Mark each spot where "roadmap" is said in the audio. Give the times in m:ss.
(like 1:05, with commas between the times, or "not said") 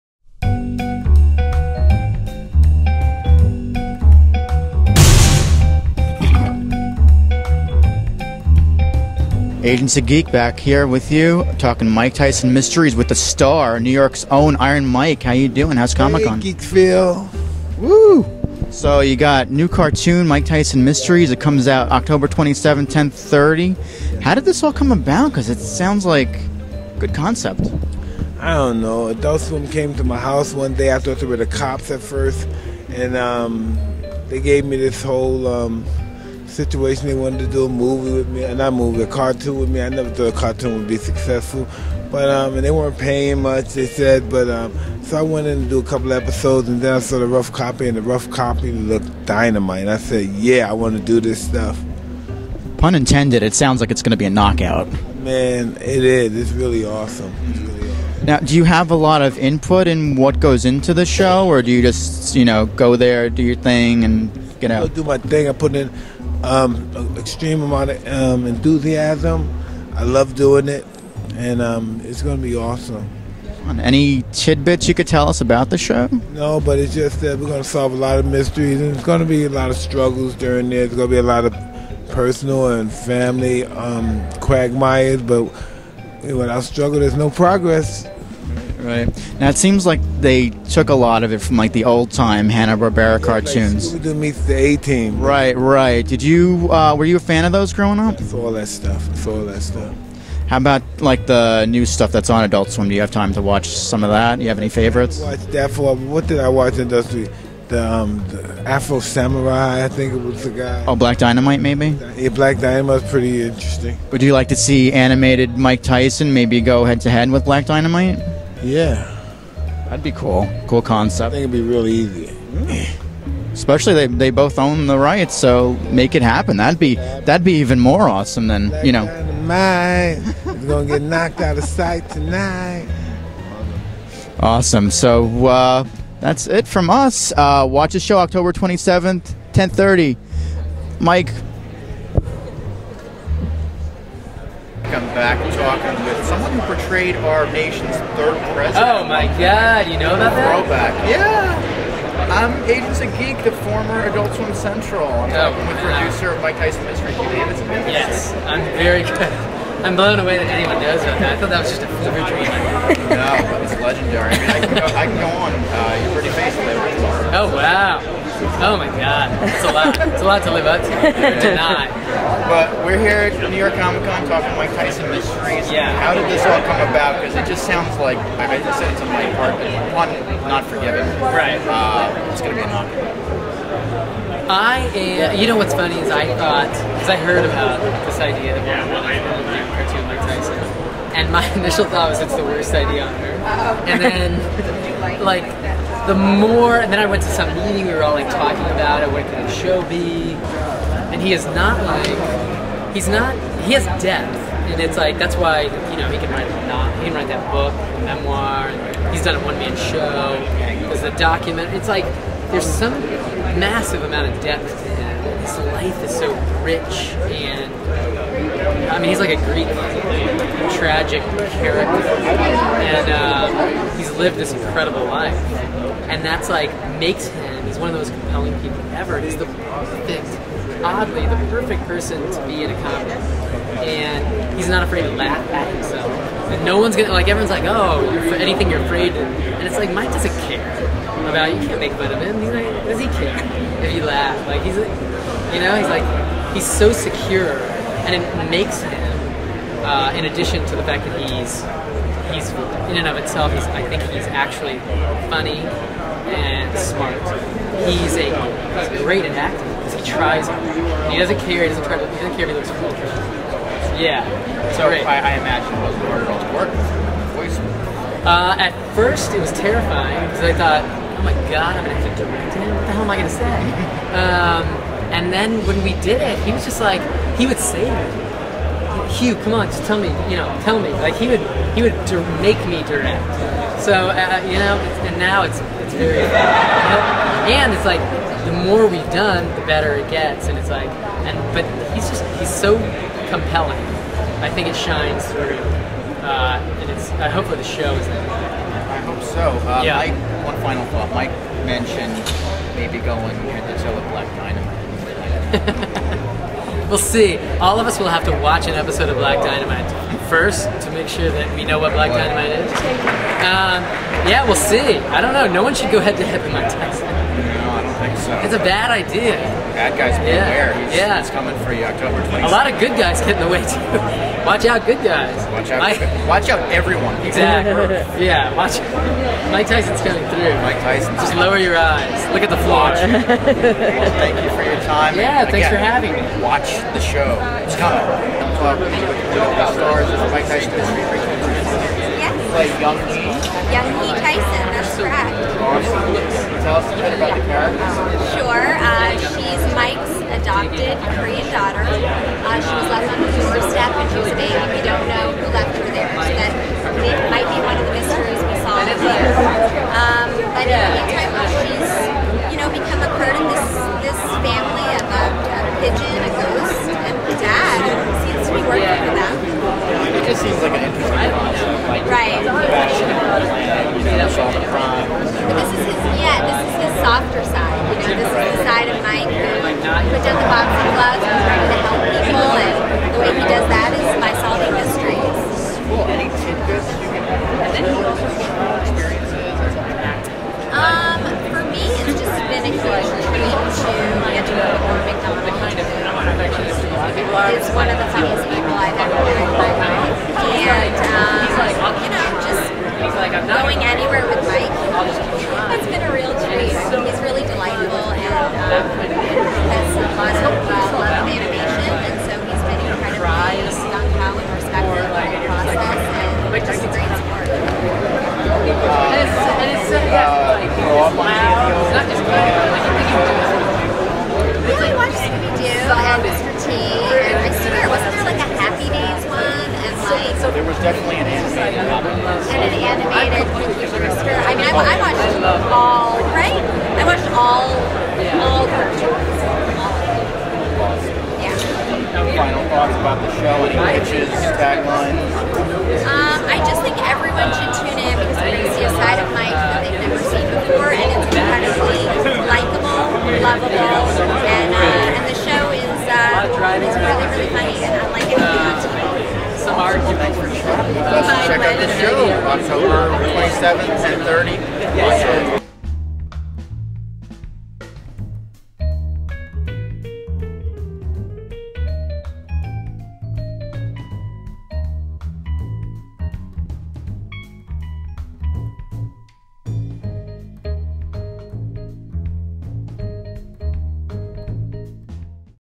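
not said.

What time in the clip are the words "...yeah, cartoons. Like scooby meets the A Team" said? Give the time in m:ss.
1:33.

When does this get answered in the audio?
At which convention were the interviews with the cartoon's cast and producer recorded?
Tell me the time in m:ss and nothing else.
2:53.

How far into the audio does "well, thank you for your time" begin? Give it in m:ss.
5:32.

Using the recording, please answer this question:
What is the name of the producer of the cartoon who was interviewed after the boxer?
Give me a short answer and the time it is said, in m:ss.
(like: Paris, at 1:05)
Hugh Davidson, at 2:37.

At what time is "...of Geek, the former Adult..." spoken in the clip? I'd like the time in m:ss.
2:32.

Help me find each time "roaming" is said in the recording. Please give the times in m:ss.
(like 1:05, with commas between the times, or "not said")
not said.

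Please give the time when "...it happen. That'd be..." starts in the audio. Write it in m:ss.
2:06.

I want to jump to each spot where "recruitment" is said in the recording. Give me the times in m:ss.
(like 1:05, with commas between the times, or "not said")
not said.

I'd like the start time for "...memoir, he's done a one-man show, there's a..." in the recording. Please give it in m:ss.
3:28.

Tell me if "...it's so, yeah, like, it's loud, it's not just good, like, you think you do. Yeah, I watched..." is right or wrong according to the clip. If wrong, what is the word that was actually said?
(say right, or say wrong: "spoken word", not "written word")
right.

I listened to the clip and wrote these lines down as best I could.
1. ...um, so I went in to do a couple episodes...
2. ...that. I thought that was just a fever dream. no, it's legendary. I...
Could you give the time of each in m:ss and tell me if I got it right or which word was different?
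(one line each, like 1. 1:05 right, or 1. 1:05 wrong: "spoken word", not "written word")
1. 0:44 right
2. 2:41 right.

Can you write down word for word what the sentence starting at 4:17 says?
He's a he's great at acting because he tries.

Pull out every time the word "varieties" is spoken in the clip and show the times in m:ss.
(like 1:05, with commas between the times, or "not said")
not said.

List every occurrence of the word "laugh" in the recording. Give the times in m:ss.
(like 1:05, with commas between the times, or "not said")
3:55, 4:04.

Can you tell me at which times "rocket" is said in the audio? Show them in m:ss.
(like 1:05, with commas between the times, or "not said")
not said.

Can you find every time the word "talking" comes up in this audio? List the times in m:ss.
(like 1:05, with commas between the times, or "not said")
0:11, 2:25, 2:54, 3:18.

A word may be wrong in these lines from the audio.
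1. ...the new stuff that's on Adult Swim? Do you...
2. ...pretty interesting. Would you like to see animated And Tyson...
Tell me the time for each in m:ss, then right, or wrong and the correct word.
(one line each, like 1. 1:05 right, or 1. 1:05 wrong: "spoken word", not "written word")
1. 1:41 right
2. 1:53 wrong: "Mike", not "And".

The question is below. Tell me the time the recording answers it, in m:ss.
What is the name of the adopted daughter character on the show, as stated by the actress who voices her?
5:42.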